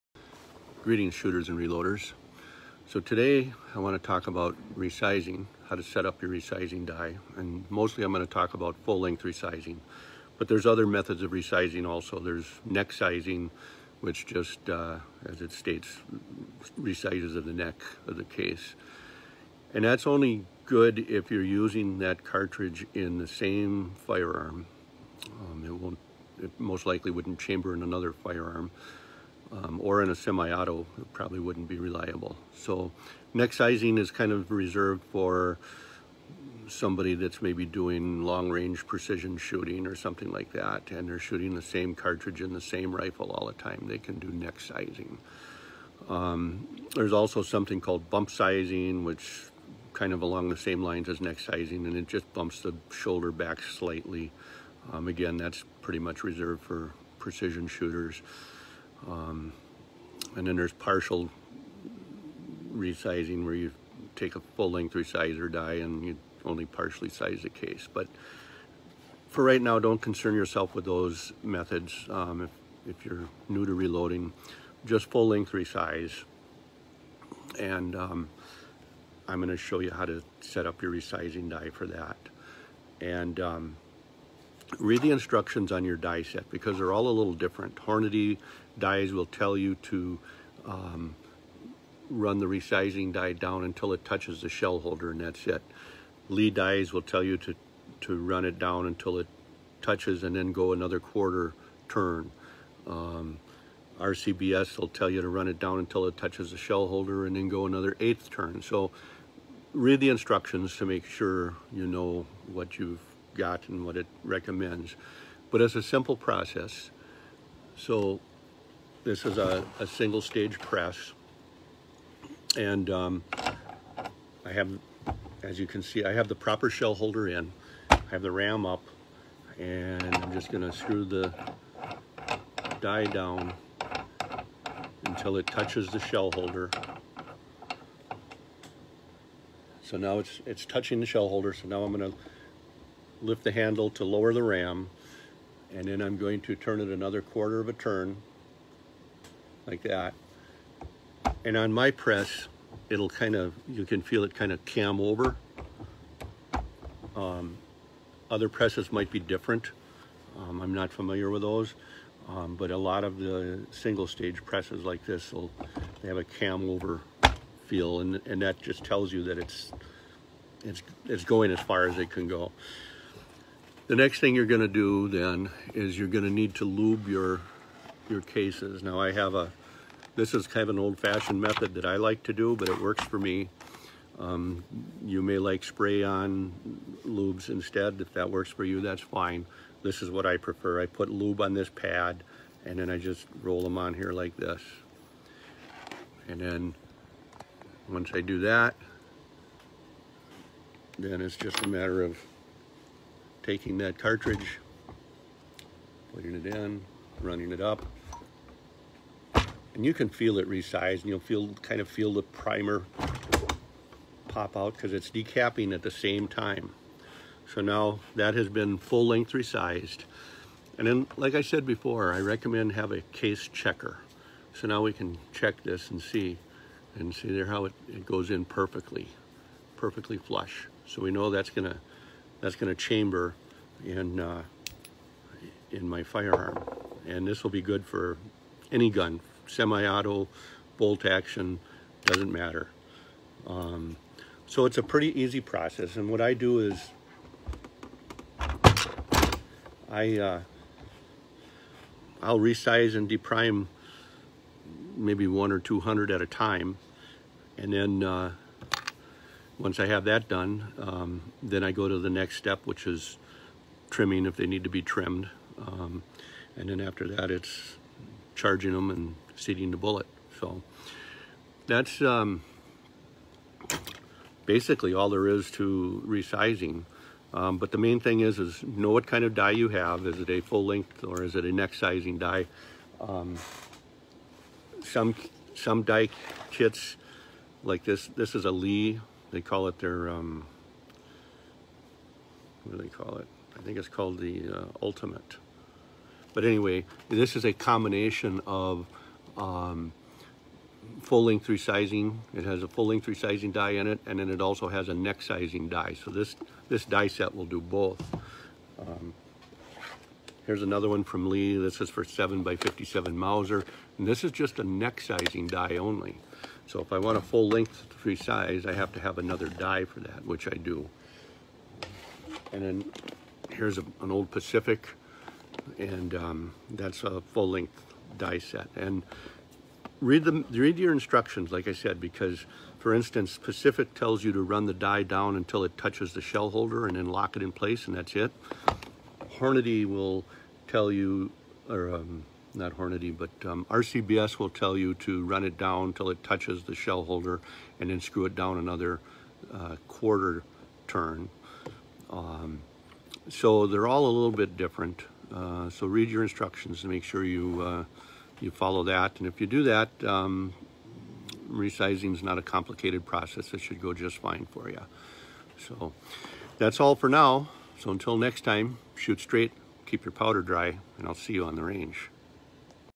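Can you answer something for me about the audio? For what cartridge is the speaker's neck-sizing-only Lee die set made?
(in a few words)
7x57 Mauser.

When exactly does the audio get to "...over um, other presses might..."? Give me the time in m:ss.
2:34.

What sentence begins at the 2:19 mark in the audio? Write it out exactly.
So now it's, it's touching the shell holder.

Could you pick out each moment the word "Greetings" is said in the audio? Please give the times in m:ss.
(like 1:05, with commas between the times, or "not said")
0:00.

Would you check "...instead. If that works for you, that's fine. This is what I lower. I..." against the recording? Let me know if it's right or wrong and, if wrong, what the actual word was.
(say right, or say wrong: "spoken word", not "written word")
wrong: "prefer", not "lower".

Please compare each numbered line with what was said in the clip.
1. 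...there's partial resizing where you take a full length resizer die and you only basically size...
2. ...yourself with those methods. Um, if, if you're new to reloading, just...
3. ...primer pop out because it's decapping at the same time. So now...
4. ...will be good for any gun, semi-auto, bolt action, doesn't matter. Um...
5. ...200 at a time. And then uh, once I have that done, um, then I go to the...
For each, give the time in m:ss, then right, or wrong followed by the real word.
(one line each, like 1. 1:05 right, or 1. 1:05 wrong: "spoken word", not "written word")
1. 1:00 wrong: "partially", not "basically"
2. 1:10 right
3. 3:32 right
4. 3:57 right
5. 4:15 right.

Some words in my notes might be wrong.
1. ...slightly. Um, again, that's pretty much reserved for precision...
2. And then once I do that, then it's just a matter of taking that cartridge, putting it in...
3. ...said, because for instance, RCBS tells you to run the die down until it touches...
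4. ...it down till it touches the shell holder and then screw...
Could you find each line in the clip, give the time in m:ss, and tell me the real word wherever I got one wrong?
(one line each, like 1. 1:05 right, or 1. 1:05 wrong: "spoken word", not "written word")
1. 0:53 right
2. 3:16 right
3. 5:31 wrong: "Pacific", not "RCBS"
4. 5:45 right.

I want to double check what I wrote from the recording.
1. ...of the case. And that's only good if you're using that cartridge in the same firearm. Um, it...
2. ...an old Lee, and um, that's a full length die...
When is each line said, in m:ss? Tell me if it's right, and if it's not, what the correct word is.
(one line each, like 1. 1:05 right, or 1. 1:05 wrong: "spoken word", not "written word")
1. 0:18 right
2. 5:24 wrong: "Pacific", not "Lee".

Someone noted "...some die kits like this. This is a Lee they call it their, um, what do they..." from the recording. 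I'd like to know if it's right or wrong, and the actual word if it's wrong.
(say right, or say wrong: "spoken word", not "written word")
right.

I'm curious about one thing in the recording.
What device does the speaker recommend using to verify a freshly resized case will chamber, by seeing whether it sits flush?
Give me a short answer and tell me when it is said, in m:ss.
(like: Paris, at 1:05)
case checker, at 3:43.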